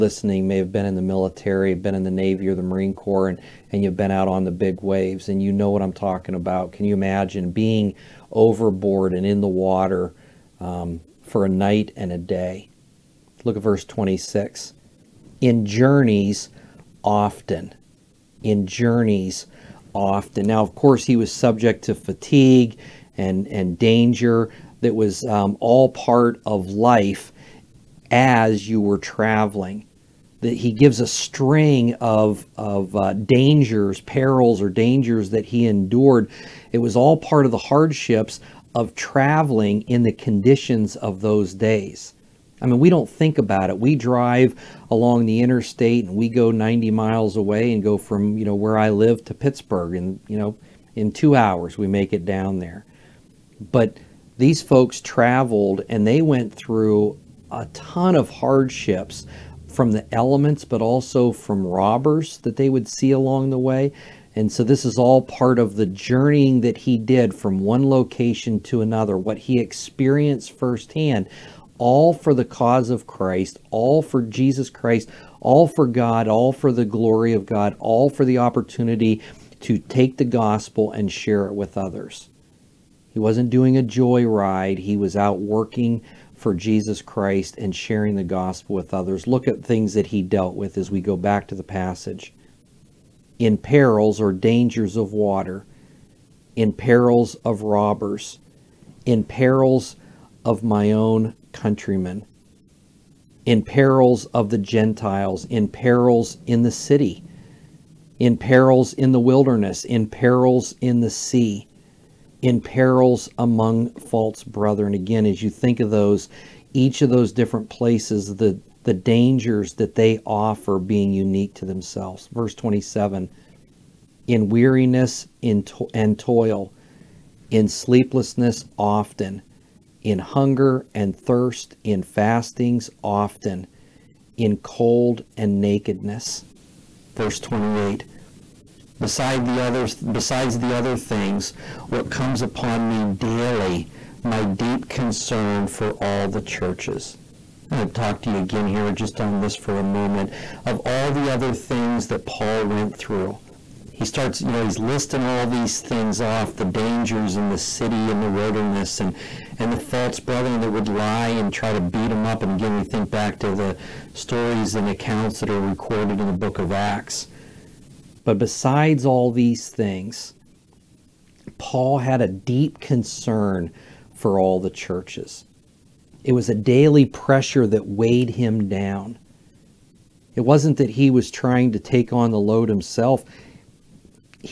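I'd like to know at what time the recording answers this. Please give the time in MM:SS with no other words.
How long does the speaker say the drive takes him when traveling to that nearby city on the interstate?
00:51.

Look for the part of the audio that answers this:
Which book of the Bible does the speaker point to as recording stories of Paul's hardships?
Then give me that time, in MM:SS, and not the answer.
02:46.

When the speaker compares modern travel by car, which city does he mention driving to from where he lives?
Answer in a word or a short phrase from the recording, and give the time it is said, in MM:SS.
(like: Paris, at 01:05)
Pittsburgh, at 00:49.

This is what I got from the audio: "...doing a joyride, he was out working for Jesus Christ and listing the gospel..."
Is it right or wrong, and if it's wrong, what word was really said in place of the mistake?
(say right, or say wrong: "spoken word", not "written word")
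wrong: "sharing", not "listing".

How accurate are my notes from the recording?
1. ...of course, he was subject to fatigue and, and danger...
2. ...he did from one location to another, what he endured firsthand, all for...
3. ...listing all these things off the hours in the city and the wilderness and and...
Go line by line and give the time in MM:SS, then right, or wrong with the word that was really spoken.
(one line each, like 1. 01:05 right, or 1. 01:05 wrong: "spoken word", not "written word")
1. 00:20 right
2. 01:06 wrong: "experienced", not "endured"
3. 02:34 wrong: "dangers", not "hours".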